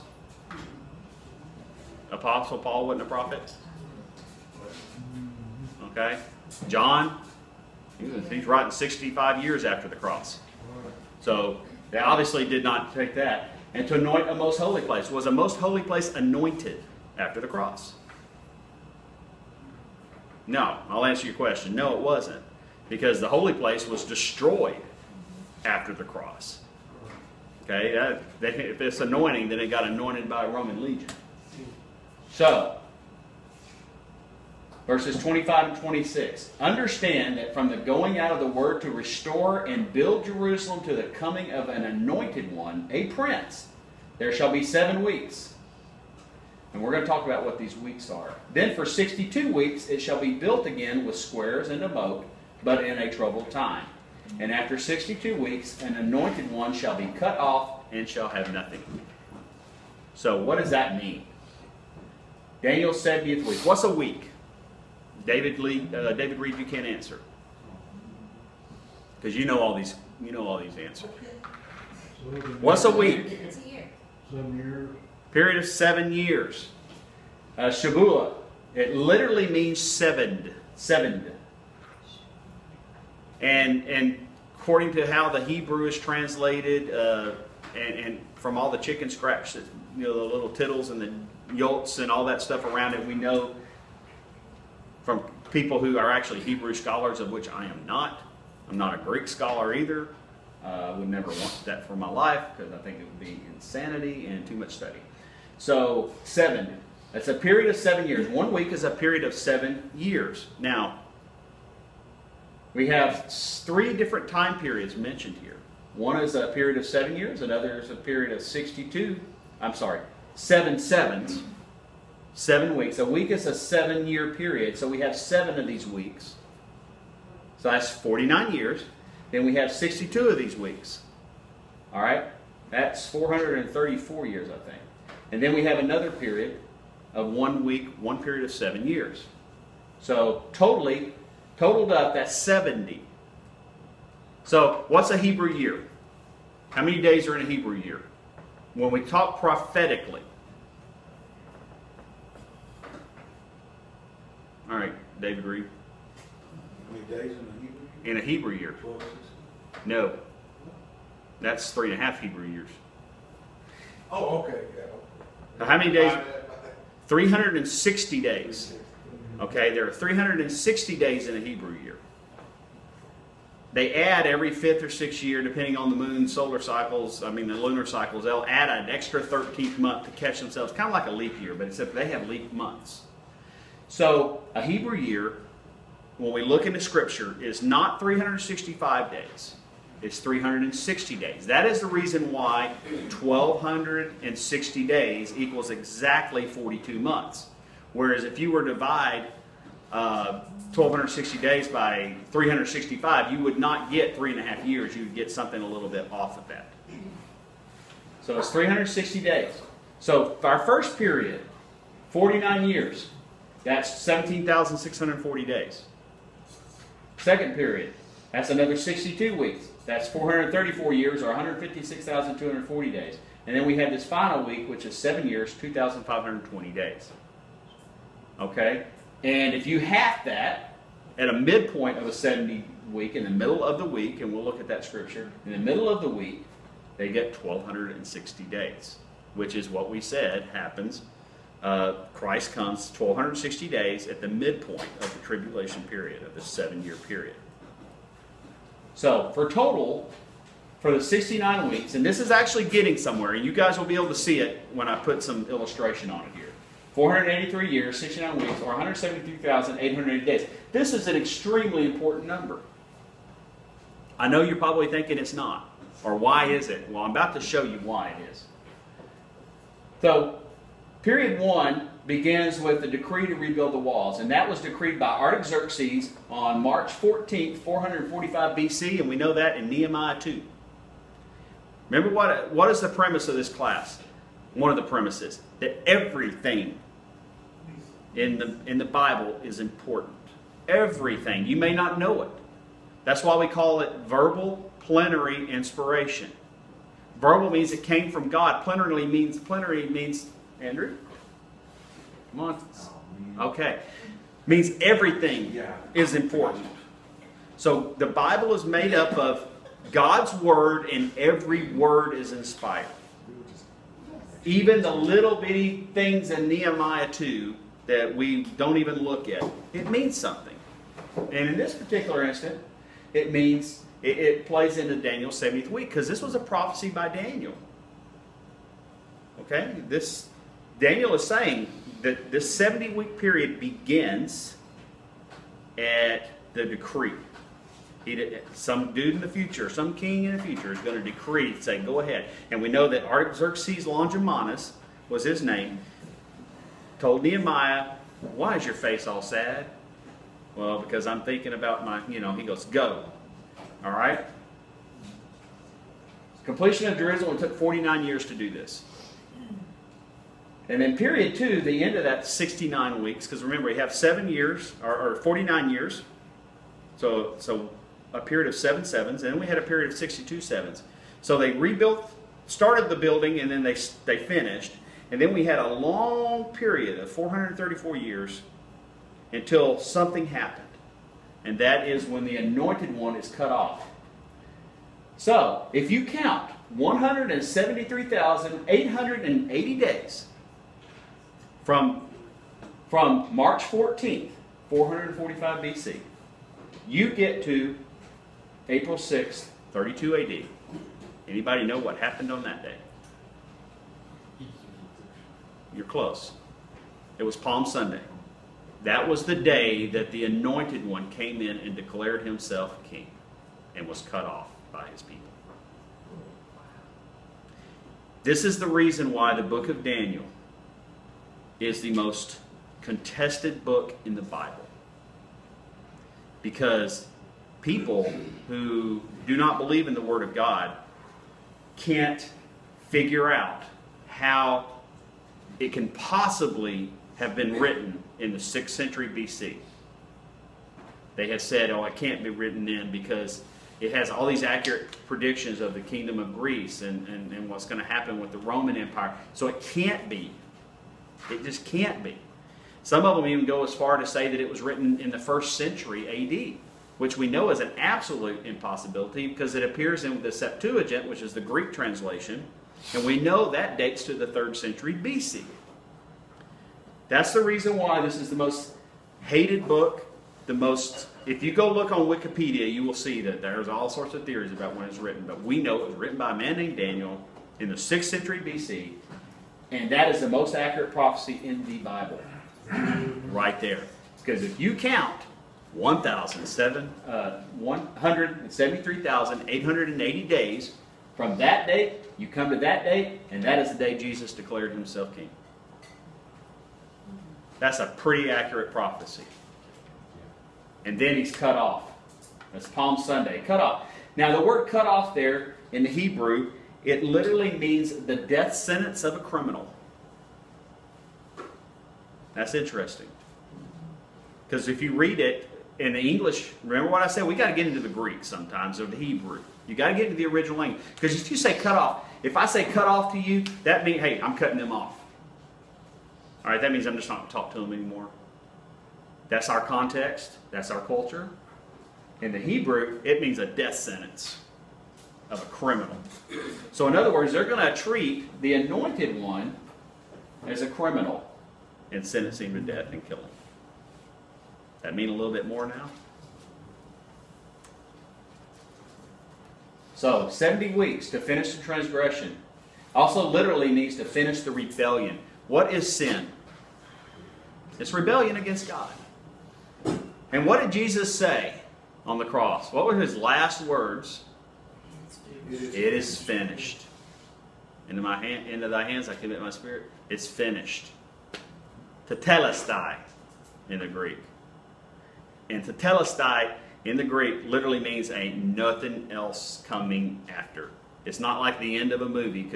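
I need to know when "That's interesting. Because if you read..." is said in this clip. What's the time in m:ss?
8:32.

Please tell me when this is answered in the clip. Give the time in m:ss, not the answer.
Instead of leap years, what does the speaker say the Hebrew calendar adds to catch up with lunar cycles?
3:02.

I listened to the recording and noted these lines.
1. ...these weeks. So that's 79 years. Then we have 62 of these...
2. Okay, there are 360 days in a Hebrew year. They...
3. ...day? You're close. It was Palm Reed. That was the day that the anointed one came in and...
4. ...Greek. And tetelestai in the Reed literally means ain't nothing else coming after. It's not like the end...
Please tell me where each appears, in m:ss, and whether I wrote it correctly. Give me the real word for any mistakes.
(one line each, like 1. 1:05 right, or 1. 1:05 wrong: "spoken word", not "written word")
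1. 2:05 wrong: "49", not "79"
2. 2:49 right
3. 6:42 wrong: "Sunday", not "Reed"
4. 9:33 wrong: "Greek", not "Reed".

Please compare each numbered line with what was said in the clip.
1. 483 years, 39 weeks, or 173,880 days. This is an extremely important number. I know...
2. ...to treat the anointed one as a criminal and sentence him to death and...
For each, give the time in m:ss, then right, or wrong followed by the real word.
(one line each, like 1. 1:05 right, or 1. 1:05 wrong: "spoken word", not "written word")
1. 4:16 wrong: "69", not "39"
2. 8:57 right.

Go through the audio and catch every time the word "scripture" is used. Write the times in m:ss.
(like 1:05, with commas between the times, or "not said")
3:06, 3:54.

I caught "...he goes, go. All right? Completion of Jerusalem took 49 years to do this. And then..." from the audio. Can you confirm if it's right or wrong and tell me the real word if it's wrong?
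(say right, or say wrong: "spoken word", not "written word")
right.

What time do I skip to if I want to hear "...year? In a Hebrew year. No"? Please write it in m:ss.
2:37.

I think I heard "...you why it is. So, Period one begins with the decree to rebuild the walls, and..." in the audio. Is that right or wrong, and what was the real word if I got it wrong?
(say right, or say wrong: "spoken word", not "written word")
right.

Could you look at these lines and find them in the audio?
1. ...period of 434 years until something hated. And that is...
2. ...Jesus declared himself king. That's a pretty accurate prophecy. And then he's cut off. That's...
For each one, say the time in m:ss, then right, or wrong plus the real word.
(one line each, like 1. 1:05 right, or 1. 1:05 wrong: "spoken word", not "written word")
1. 6:16 wrong: "happened", not "hated"
2. 8:13 right.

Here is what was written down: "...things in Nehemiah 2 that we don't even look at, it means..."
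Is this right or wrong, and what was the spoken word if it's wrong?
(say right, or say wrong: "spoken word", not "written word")
right.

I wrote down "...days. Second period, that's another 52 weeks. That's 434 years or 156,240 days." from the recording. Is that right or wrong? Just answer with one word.
wrong.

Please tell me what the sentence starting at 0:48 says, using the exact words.
Then for 62 weeks it shall be built again with squares and a moat, but in a troubled time.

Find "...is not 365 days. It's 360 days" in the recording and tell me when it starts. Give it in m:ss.
3:07.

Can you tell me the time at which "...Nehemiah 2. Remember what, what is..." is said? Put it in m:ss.
4:39.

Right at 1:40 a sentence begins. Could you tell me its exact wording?
I uh, would never want that for my life because I think it would be insanity and too much study.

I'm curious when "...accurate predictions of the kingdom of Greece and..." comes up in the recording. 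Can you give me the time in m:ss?
7:24.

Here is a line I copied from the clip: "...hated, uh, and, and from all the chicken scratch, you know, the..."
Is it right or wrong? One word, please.
wrong.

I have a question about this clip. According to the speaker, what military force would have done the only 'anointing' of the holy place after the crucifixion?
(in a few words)
Roman legion.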